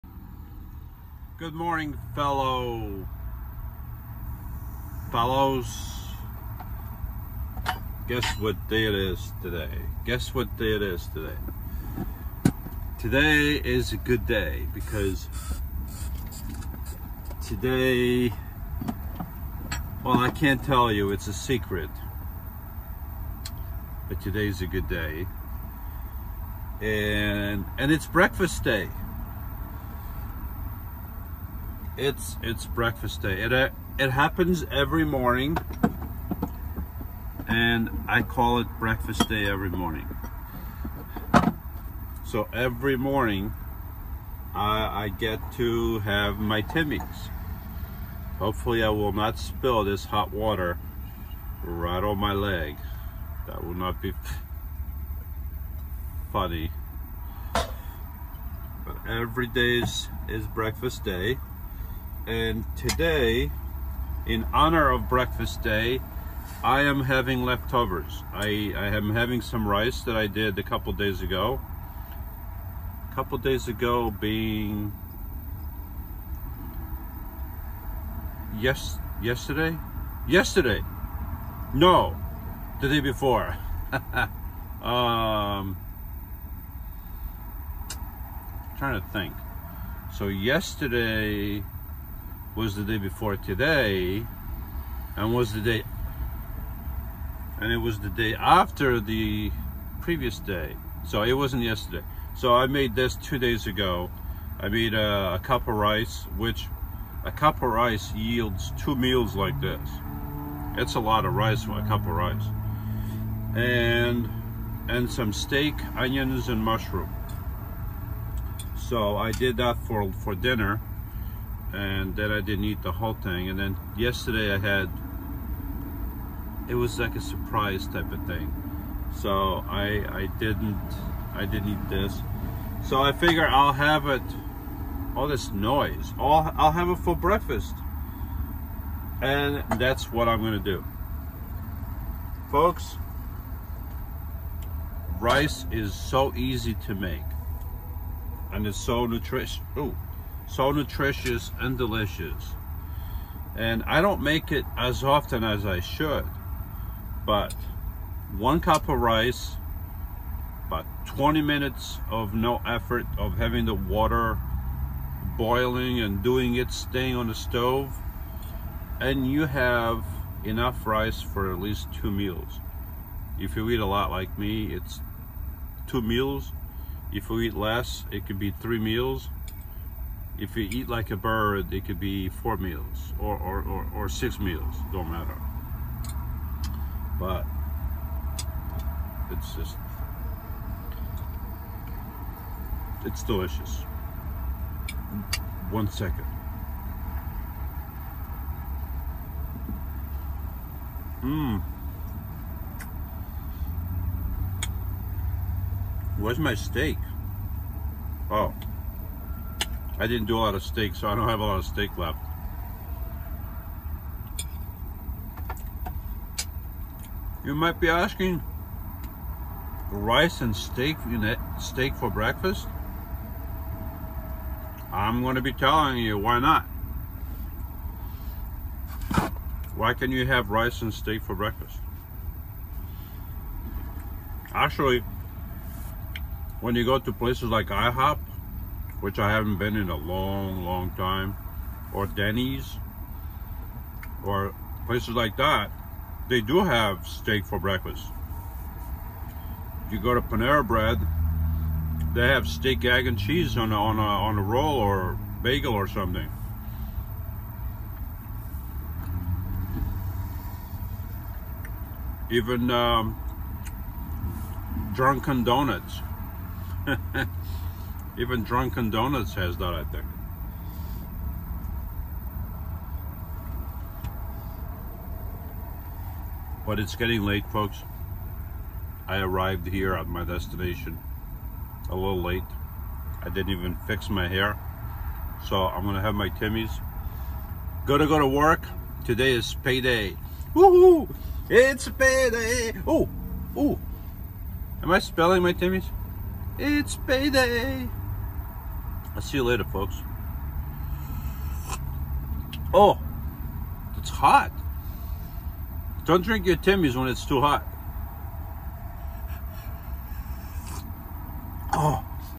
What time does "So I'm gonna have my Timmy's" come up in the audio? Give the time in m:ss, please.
4:45.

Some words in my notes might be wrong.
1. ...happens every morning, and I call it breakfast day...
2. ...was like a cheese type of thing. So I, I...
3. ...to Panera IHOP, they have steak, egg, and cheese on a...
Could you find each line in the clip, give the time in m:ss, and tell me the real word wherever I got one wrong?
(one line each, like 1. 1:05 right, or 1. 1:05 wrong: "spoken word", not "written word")
1. 0:34 right
2. 2:06 wrong: "surprise", not "cheese"
3. 4:10 wrong: "Bread", not "IHOP".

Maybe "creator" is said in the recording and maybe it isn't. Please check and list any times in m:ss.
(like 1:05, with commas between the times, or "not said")
not said.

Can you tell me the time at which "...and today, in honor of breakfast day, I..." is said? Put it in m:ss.
1:02.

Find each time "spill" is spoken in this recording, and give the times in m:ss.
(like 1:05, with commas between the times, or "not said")
0:49.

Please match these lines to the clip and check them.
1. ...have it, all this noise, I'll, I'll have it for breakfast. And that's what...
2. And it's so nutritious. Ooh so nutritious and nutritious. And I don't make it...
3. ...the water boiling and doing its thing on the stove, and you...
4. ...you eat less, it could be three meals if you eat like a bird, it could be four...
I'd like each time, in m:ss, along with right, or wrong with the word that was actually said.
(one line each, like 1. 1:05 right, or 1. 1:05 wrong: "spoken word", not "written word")
1. 2:13 right
2. 2:28 wrong: "delicious", not "nutritious"
3. 2:43 right
4. 2:57 right.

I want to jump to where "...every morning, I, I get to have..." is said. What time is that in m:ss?
0:42.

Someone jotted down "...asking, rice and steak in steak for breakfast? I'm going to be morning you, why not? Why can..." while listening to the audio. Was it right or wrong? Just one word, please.
wrong.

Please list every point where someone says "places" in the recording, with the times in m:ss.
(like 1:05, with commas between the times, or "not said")
3:57, 4:04.